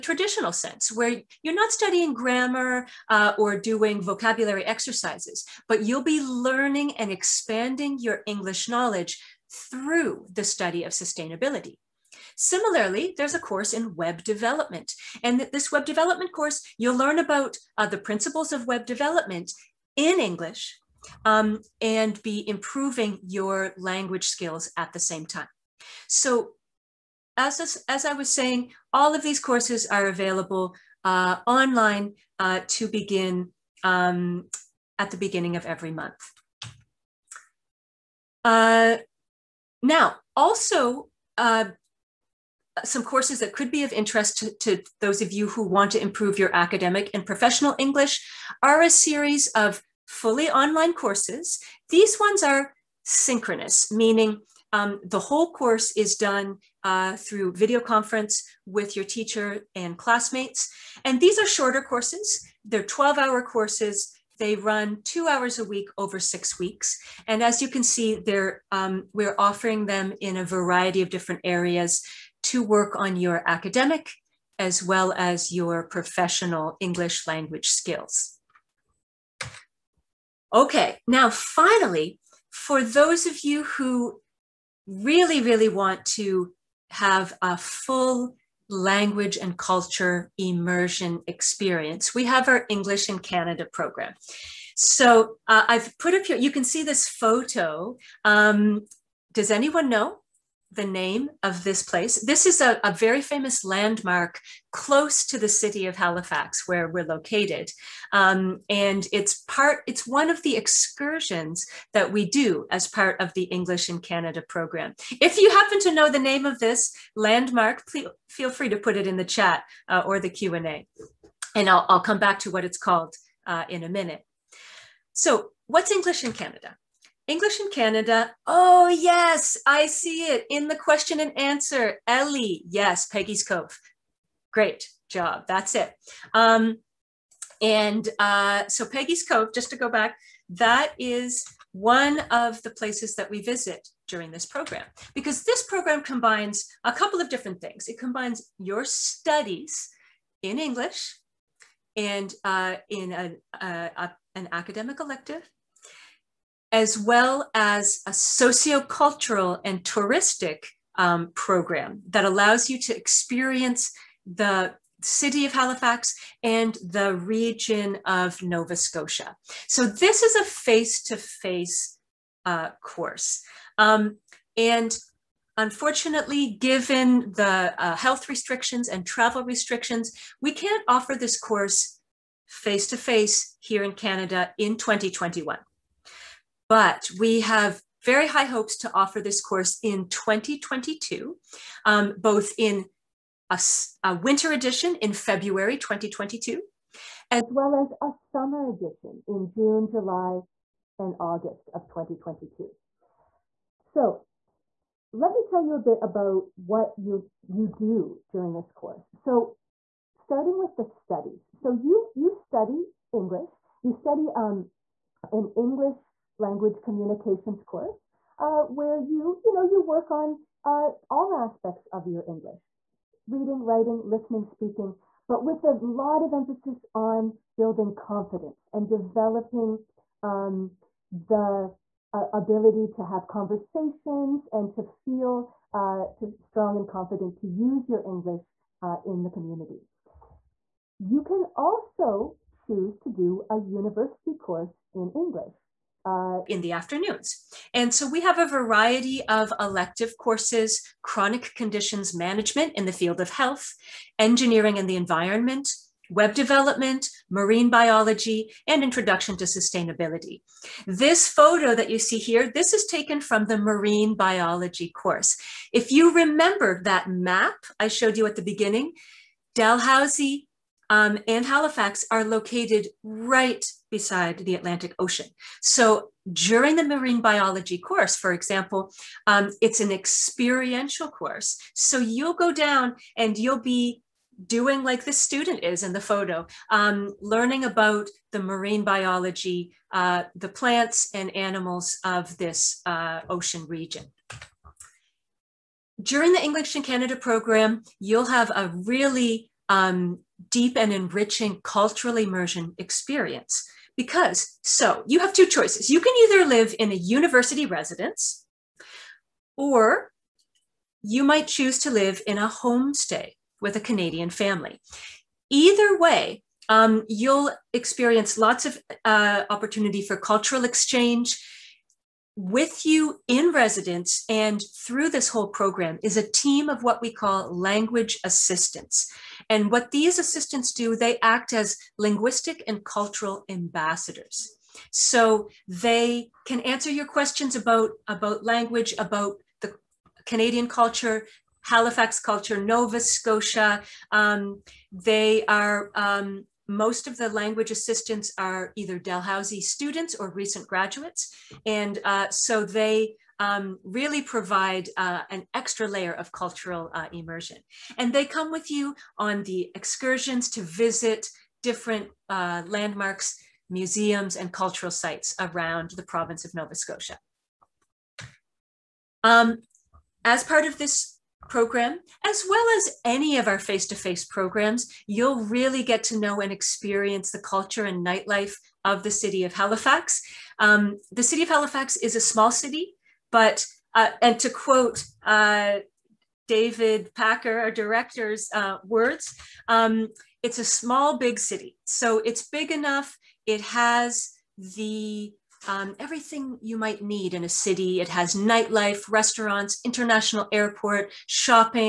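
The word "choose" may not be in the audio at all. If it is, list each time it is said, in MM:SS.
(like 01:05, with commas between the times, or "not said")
04:02, 05:11.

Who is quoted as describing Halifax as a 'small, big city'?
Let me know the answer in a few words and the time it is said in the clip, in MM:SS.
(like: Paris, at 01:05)
David Packer, at 06:26.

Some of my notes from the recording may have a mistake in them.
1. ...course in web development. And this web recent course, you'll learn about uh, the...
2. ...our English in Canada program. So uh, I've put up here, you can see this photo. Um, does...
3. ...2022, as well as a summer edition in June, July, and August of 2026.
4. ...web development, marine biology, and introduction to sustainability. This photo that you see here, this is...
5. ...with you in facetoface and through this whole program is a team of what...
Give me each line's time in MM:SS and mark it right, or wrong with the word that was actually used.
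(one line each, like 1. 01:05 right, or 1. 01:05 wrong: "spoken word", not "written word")
1. 00:13 wrong: "development", not "recent"
2. 01:32 right
3. 03:15 wrong: "2022", not "2026"
4. 04:16 right
5. 05:22 wrong: "residence", not "facetoface".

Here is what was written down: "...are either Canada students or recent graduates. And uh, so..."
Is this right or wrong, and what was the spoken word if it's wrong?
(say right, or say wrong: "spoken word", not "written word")
wrong: "Dalhousie", not "Canada".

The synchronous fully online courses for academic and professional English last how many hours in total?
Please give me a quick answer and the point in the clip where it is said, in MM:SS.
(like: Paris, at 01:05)
12 hours, at 01:02.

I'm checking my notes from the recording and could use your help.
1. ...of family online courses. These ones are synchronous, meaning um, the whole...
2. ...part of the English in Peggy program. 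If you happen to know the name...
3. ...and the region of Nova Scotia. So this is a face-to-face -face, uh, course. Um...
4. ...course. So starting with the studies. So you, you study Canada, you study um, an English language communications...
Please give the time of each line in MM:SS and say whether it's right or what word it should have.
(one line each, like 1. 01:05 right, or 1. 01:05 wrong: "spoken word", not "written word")
1. 00:49 wrong: "fully", not "family"
2. 01:52 wrong: "Canada", not "Peggy"
3. 02:46 right
4. 03:28 wrong: "English", not "Canada".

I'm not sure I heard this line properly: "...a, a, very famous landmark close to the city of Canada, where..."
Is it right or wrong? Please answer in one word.
wrong.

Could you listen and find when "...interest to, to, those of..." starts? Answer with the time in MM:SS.
00:43.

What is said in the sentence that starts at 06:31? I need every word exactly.
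So it's big enough, it has the um, everything you might need in a city.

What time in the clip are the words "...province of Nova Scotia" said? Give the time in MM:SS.
06:06.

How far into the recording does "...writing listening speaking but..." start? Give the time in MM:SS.
03:43.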